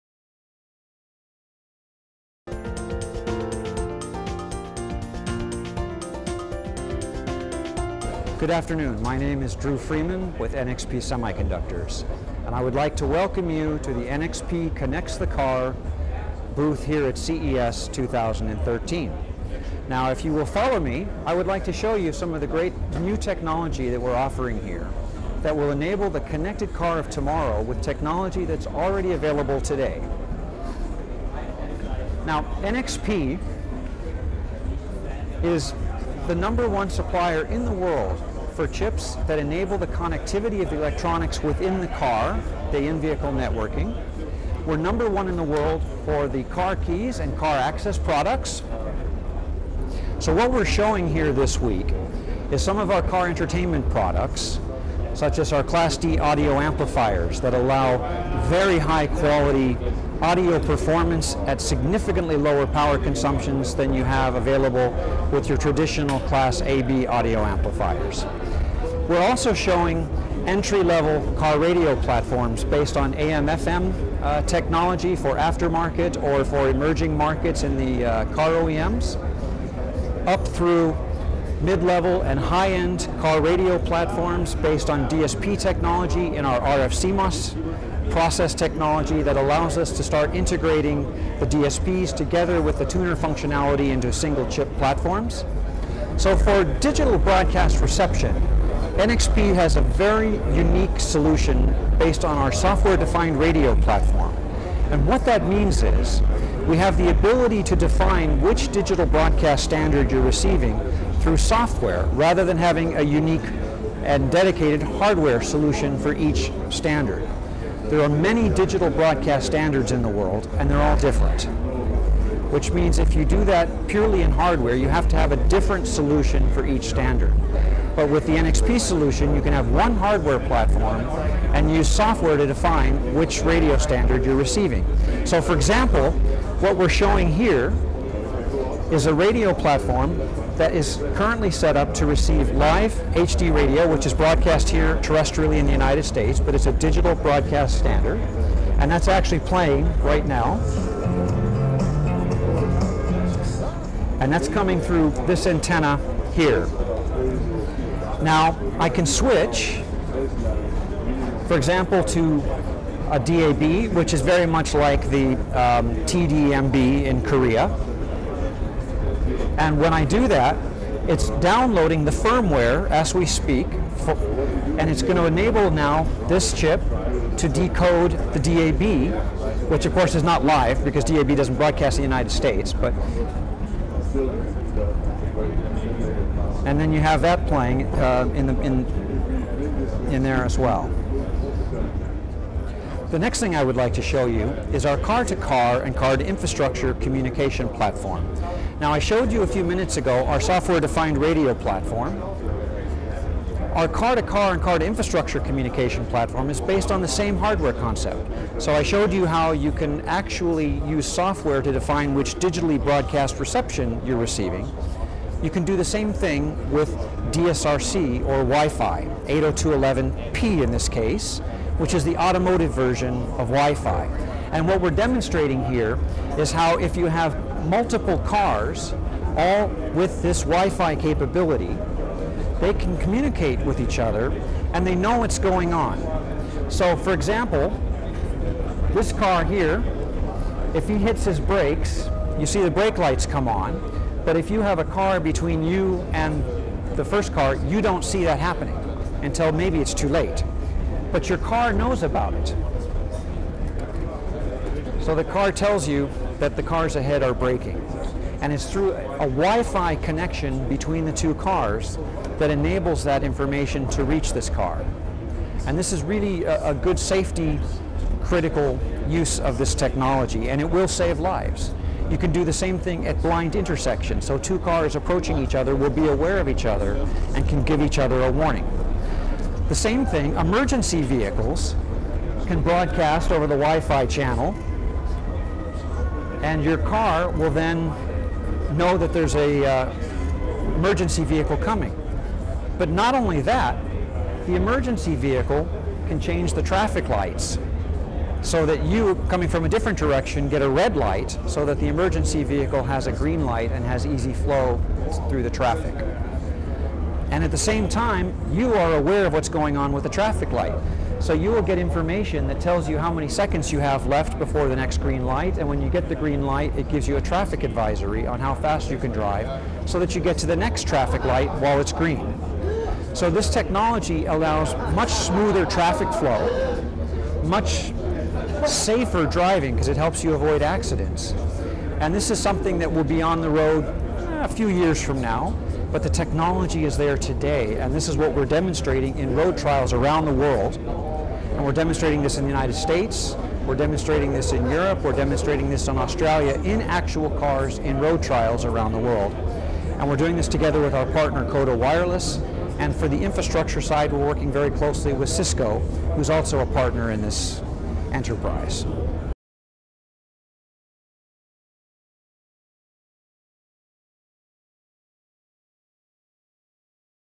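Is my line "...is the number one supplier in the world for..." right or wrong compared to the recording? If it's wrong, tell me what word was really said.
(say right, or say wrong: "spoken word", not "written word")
right.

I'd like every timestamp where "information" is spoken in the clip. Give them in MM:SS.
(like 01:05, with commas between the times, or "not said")
04:23, 05:11.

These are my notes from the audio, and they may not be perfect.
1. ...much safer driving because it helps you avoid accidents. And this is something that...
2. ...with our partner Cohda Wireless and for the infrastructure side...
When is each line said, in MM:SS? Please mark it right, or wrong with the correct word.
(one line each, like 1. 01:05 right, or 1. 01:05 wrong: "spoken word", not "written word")
1. 05:27 right
2. 05:50 right.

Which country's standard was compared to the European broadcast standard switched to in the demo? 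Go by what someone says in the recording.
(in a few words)
Korea.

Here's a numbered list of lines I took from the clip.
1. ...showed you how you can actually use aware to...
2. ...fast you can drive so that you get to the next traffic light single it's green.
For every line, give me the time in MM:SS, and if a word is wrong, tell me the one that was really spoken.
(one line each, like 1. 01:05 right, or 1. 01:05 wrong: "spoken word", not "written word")
1. 03:28 wrong: "software", not "aware"
2. 05:18 wrong: "while", not "single".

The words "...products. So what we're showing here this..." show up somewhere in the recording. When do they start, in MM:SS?
00:47.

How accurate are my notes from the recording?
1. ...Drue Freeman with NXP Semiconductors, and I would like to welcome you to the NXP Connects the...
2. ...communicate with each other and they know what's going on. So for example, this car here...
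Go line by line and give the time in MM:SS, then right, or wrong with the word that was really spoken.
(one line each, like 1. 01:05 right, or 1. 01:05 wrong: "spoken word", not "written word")
1. 00:09 right
2. 03:52 right.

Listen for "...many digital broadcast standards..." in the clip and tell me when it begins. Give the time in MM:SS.
01:58.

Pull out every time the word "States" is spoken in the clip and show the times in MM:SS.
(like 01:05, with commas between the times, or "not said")
02:26, 03:02, 05:42.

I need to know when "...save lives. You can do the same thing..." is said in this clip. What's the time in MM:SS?
04:30.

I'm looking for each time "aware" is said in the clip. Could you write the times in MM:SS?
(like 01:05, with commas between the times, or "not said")
04:36, 05:08.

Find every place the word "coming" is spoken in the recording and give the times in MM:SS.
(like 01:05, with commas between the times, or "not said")
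02:34, 04:51, 04:59.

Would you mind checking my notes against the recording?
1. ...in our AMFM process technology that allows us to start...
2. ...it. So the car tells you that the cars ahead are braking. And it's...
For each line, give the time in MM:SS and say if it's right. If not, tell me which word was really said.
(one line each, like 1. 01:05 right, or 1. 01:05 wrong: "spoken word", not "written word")
1. 01:26 wrong: "RFCMOS", not "AMFM"
2. 04:12 right.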